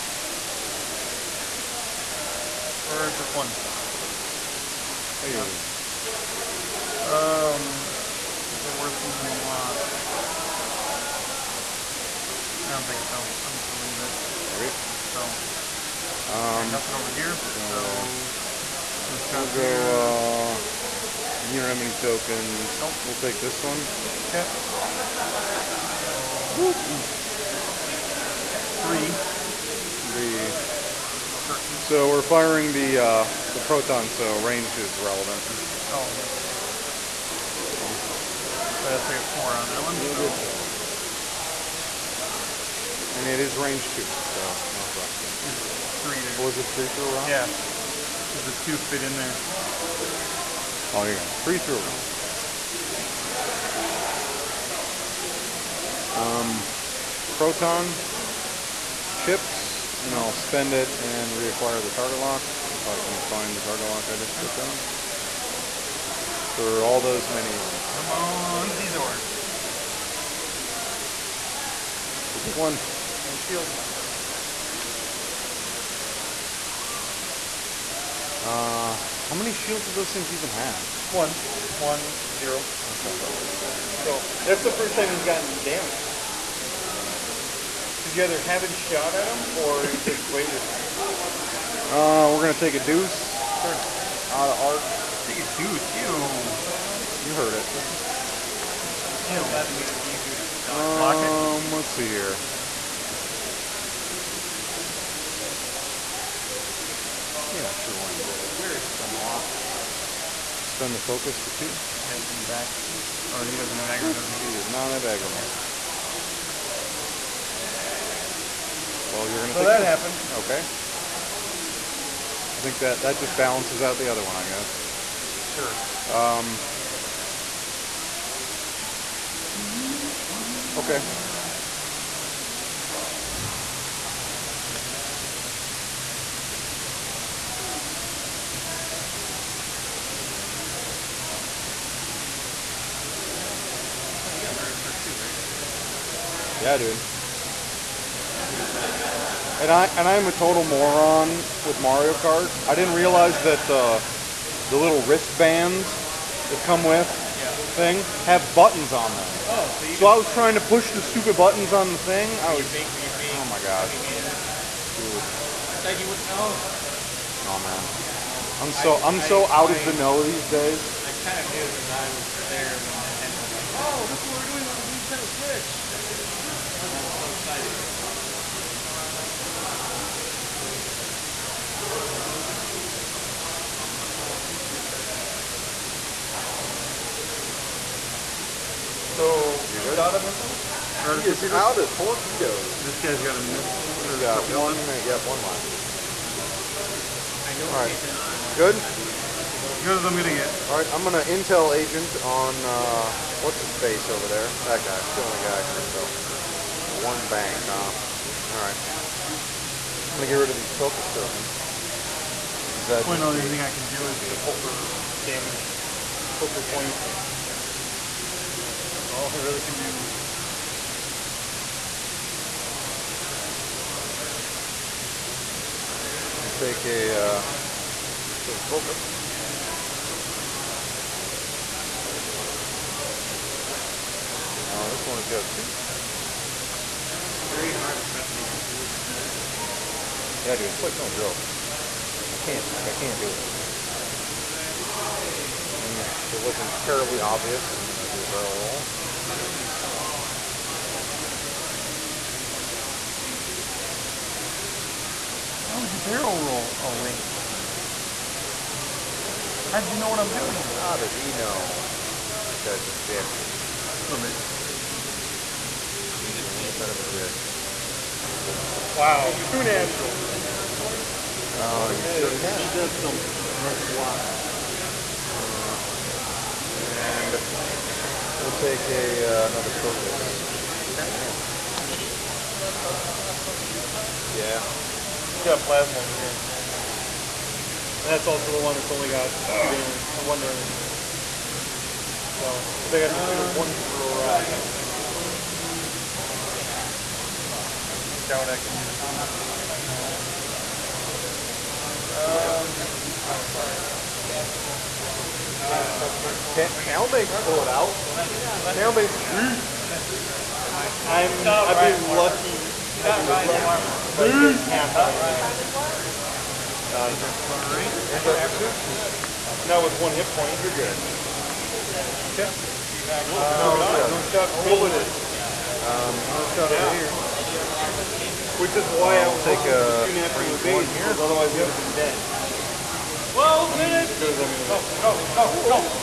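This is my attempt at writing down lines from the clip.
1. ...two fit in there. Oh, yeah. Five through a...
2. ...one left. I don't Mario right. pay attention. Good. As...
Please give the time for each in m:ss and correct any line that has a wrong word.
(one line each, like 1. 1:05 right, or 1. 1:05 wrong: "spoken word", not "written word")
1. 0:48 wrong: "Three", not "Five"
2. 3:15 wrong: "All", not "Mario".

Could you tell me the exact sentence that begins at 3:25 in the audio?
It's the only guy I can intel one bank, huh?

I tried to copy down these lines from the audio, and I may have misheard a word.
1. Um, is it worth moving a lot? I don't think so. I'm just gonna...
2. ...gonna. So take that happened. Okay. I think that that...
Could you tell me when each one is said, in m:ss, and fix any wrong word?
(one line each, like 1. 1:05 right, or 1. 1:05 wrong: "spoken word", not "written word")
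1. 0:07 right
2. 1:59 right.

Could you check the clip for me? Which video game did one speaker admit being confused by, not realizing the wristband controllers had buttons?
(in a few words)
Mario Kart.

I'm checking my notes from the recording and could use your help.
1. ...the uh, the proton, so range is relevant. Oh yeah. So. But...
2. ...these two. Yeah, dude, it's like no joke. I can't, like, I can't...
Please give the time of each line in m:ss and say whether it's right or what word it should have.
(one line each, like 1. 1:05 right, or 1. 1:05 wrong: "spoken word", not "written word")
1. 0:32 right
2. 3:58 right.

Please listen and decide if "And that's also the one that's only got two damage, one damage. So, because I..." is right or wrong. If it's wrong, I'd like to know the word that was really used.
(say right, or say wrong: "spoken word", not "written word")
right.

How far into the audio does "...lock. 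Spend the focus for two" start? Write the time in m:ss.
1:49.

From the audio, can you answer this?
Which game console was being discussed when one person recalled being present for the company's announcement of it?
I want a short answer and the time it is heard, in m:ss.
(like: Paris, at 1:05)
Nintendo Switch, at 2:55.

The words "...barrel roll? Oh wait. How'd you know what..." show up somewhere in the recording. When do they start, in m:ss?
4:15.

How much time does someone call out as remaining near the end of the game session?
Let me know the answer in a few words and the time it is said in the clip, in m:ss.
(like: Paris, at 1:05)
12 minutes, at 5:33.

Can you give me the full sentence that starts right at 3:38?
That's all I really can do.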